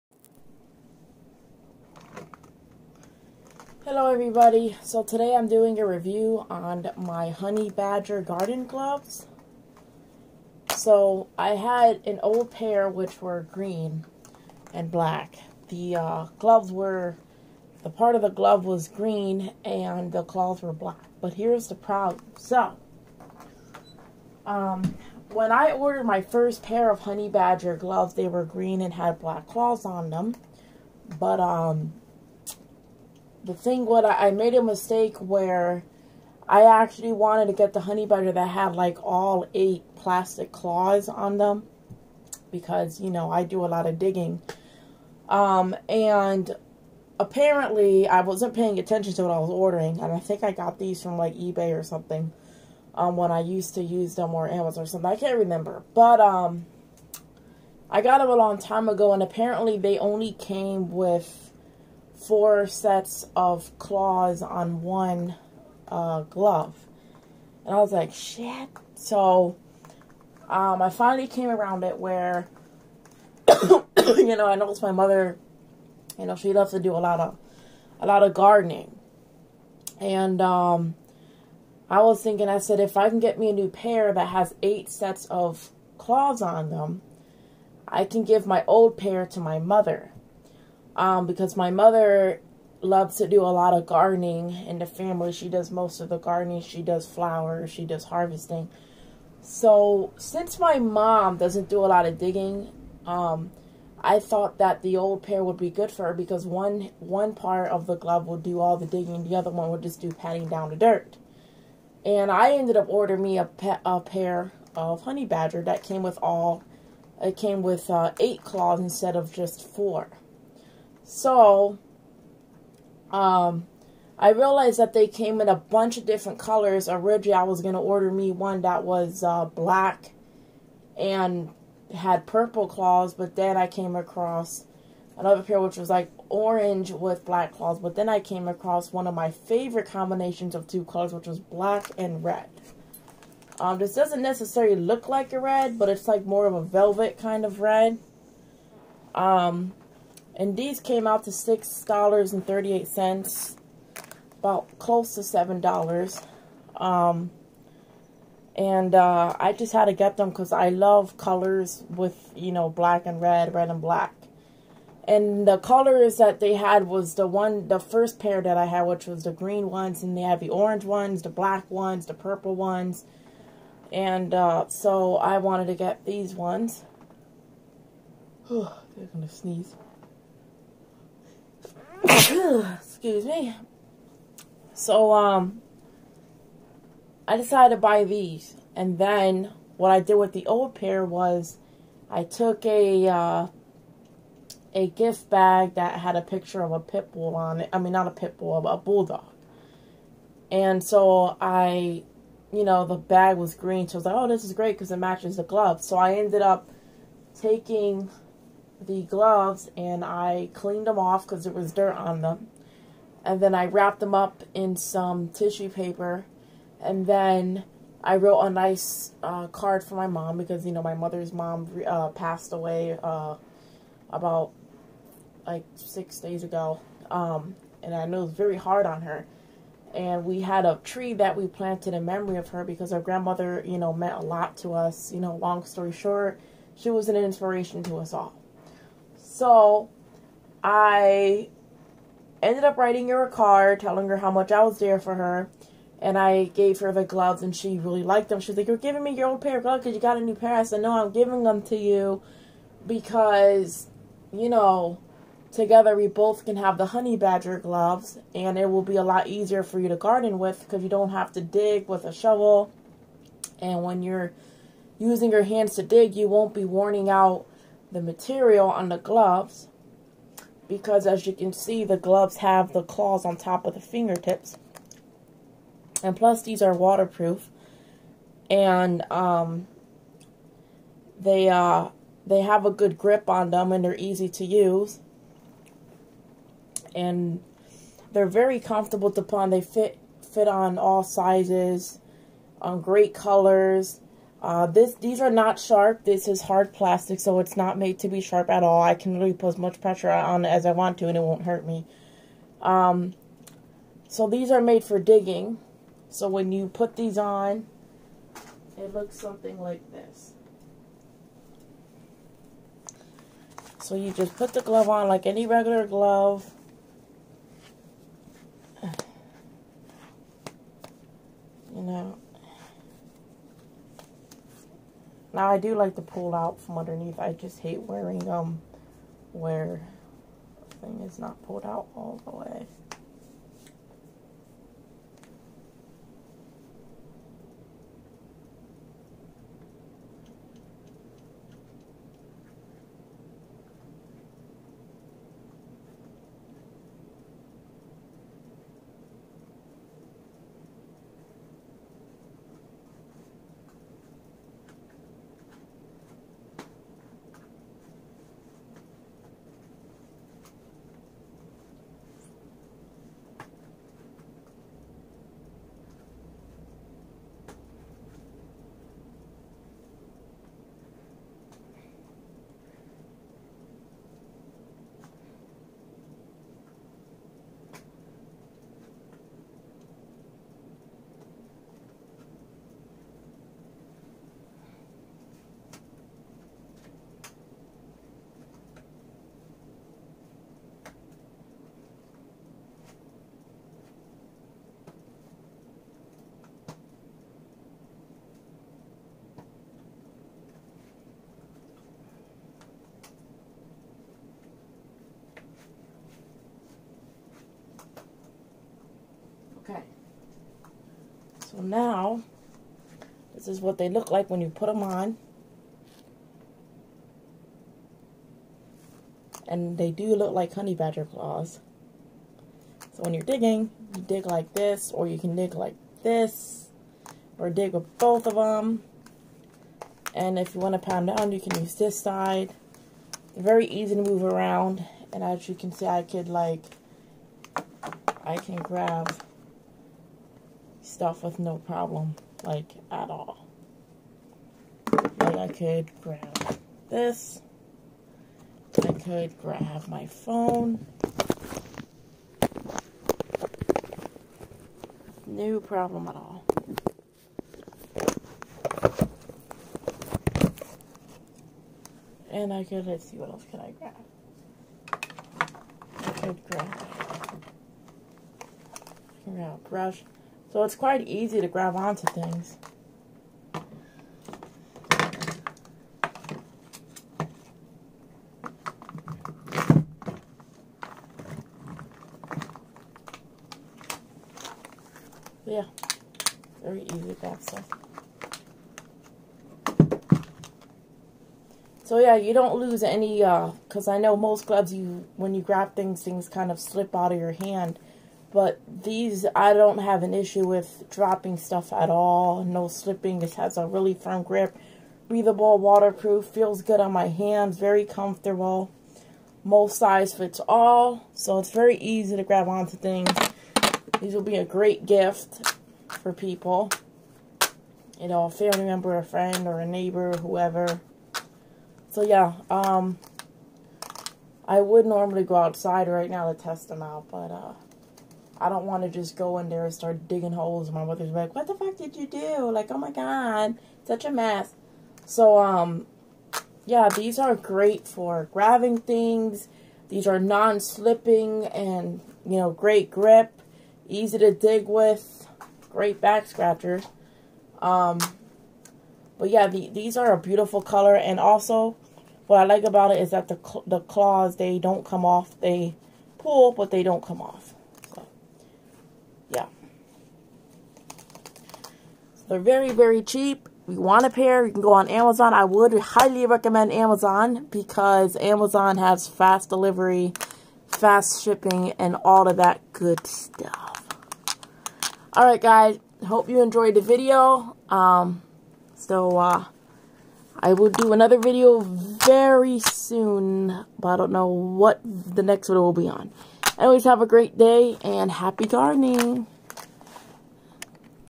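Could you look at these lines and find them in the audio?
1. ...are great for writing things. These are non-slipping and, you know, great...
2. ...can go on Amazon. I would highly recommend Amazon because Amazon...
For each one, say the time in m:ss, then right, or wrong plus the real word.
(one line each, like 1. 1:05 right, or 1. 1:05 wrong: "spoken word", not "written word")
1. 8:57 wrong: "grabbing", not "writing"
2. 9:24 right.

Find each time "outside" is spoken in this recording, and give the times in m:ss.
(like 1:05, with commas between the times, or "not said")
8:45.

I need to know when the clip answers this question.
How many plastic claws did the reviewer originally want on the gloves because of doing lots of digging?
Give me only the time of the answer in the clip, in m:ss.
0:39.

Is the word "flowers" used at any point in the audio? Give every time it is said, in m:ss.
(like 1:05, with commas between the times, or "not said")
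1:37.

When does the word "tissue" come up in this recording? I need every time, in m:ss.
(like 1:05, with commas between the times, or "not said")
3:35.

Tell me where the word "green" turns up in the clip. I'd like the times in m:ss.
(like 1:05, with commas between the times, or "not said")
0:13, 0:18, 0:28, 2:49, 3:23.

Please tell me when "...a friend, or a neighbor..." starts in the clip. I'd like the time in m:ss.
8:38.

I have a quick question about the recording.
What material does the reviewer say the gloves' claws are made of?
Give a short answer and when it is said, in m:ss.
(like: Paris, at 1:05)
hard plastic, at 4:56.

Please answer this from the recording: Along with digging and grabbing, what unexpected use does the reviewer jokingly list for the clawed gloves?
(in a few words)
back scratcher.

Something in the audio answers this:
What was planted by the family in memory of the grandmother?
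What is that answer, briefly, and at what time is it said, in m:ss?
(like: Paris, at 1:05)
a tree, at 3:50.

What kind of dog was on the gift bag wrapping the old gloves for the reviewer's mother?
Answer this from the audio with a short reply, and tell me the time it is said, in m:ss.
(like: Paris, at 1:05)
bulldog, at 3:18.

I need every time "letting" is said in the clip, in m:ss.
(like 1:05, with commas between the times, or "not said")
not said.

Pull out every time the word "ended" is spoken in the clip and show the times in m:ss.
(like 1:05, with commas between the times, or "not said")
1:52, 3:26, 4:02.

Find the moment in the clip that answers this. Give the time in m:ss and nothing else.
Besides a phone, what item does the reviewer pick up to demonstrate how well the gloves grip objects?
7:49.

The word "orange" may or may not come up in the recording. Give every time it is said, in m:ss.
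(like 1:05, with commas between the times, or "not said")
2:16, 2:50.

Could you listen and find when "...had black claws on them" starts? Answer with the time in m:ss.
0:28.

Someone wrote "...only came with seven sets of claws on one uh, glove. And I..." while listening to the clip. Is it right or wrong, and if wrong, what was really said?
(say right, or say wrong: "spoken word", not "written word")
wrong: "four", not "seven".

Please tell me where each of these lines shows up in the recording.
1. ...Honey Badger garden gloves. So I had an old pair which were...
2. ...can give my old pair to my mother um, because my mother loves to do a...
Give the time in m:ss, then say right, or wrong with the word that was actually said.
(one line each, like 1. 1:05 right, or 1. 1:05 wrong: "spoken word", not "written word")
1. 0:07 right
2. 1:28 right.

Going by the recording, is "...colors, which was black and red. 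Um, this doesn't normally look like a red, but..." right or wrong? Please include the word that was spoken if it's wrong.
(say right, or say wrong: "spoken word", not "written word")
wrong: "necessarily", not "normally".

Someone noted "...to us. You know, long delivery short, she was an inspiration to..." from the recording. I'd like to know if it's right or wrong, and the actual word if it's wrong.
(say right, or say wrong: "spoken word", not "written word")
wrong: "story", not "delivery".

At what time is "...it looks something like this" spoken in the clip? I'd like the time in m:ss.
5:08.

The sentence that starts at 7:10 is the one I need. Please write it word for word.
And if you want to pound down, you can use this side.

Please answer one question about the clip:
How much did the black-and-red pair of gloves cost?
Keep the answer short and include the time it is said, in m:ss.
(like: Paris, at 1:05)
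$6.38, at 2:31.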